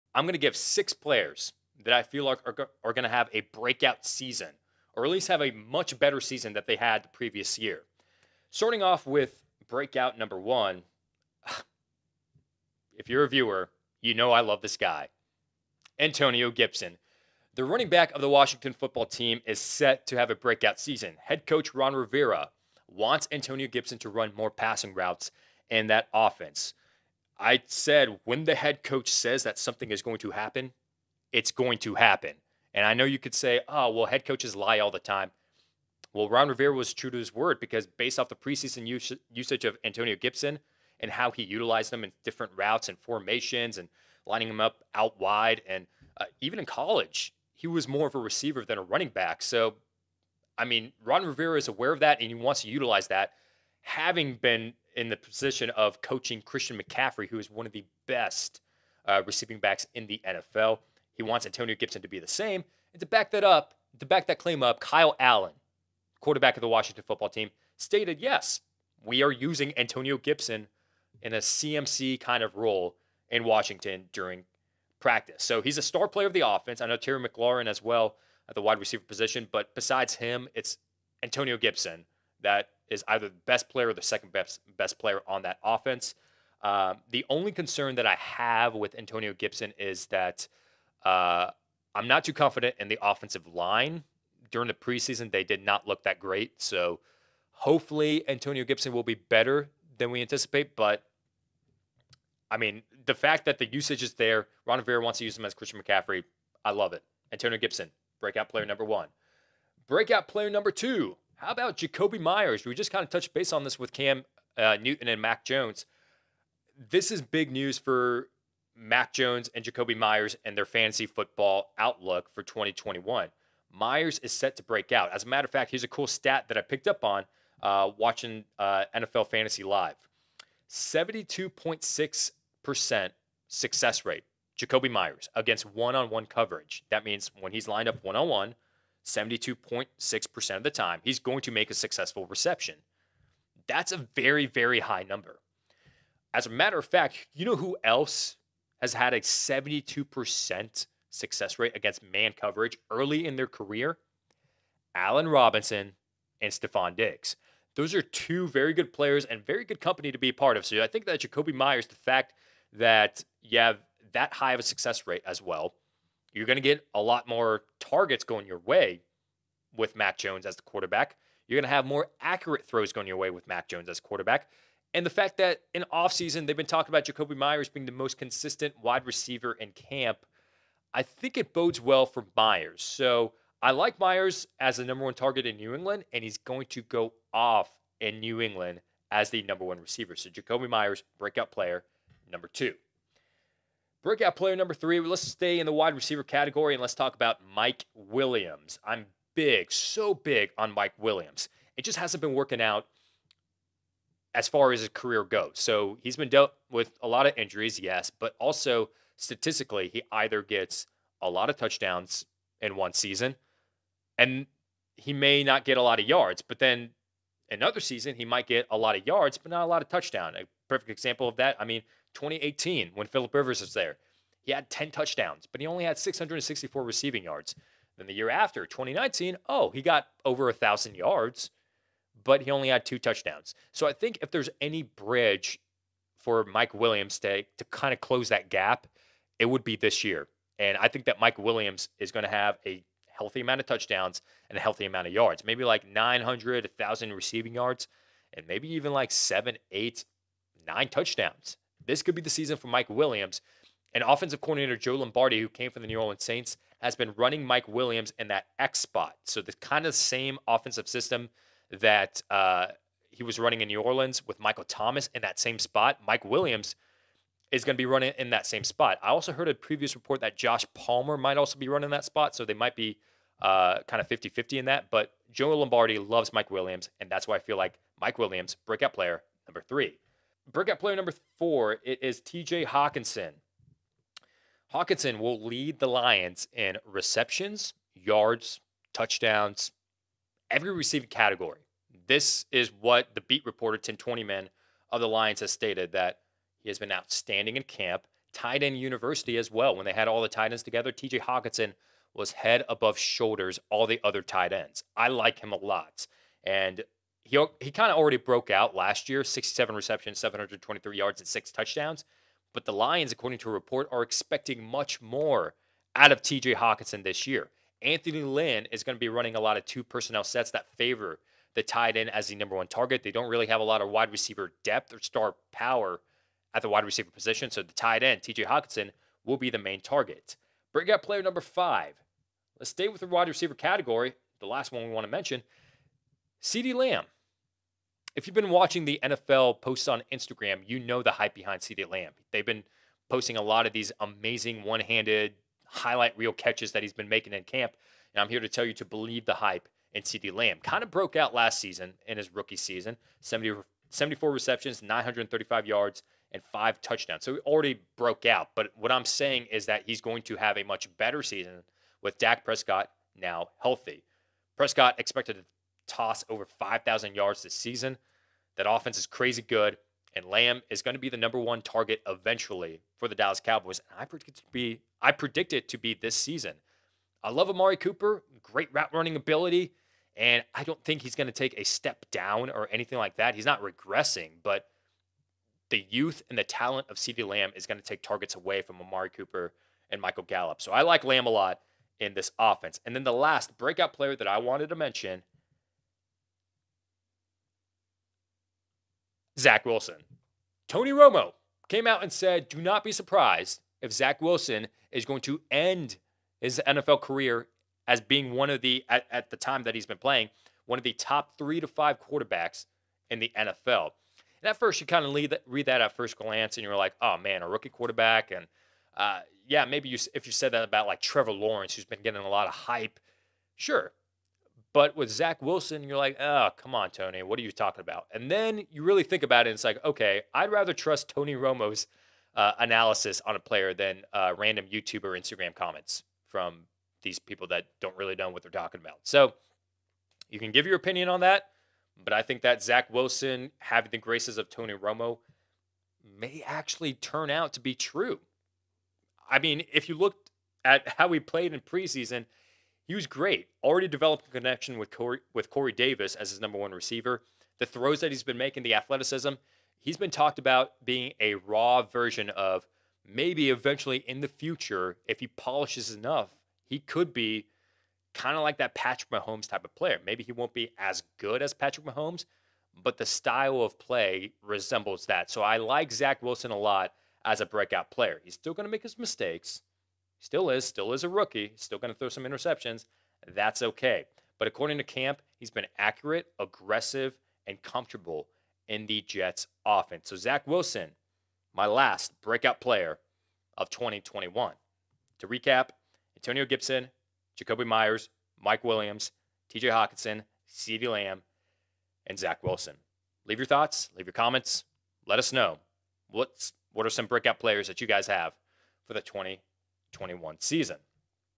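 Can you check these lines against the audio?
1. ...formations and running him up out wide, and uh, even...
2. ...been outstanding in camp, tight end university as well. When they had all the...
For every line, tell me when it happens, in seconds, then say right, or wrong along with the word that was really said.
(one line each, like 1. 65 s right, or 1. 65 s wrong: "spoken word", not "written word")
1. 42 s wrong: "lining", not "running"
2. 296 s right.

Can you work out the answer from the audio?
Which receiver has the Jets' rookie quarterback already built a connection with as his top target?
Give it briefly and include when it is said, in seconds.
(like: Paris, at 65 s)
Corey Davis, at 455 s.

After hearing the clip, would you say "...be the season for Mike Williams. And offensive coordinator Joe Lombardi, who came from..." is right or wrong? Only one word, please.
right.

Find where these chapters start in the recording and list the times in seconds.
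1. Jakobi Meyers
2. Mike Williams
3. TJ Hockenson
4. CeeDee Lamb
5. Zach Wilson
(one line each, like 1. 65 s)
1. 109 s
2. 193 s
3. 280 s
4. 333 s
5. 392 s.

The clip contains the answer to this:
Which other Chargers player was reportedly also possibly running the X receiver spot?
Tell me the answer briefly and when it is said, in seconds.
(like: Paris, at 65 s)
Josh Palmer, at 270 s.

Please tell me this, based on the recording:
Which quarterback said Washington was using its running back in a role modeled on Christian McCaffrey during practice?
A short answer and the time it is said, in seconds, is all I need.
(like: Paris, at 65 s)
Kyle Allen, at 64 s.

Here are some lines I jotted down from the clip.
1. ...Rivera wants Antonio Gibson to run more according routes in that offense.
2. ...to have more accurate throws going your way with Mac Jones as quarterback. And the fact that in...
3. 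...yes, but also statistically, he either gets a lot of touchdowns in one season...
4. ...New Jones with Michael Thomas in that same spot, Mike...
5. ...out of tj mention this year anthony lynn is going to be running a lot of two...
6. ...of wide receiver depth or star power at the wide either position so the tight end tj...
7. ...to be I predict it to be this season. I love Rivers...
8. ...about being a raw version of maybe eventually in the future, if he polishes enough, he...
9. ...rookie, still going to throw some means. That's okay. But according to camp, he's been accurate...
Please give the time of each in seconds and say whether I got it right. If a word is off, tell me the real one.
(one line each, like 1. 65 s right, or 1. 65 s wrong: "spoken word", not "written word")
1. 21 s wrong: "passing", not "according"
2. 171 s right
3. 207 s right
4. 263 s wrong: "Orleans", not "Jones"
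5. 315 s wrong: "hockenson", not "mention"
6. 323 s wrong: "receiver", not "either"
7. 374 s wrong: "Amari", not "Rivers"
8. 460 s right
9. 481 s wrong: "interceptions", not "means".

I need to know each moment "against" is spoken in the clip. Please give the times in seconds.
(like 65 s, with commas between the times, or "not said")
135 s, 151 s.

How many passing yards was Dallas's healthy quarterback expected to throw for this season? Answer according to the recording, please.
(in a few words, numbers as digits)
over 5,000.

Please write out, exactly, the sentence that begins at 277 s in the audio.
And that's why I feel like Mike Williams, breakout player number three.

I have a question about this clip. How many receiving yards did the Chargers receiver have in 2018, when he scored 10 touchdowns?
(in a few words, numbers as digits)
664.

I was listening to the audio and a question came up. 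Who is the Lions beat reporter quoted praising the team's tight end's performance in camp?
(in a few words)
Tim Twentyman.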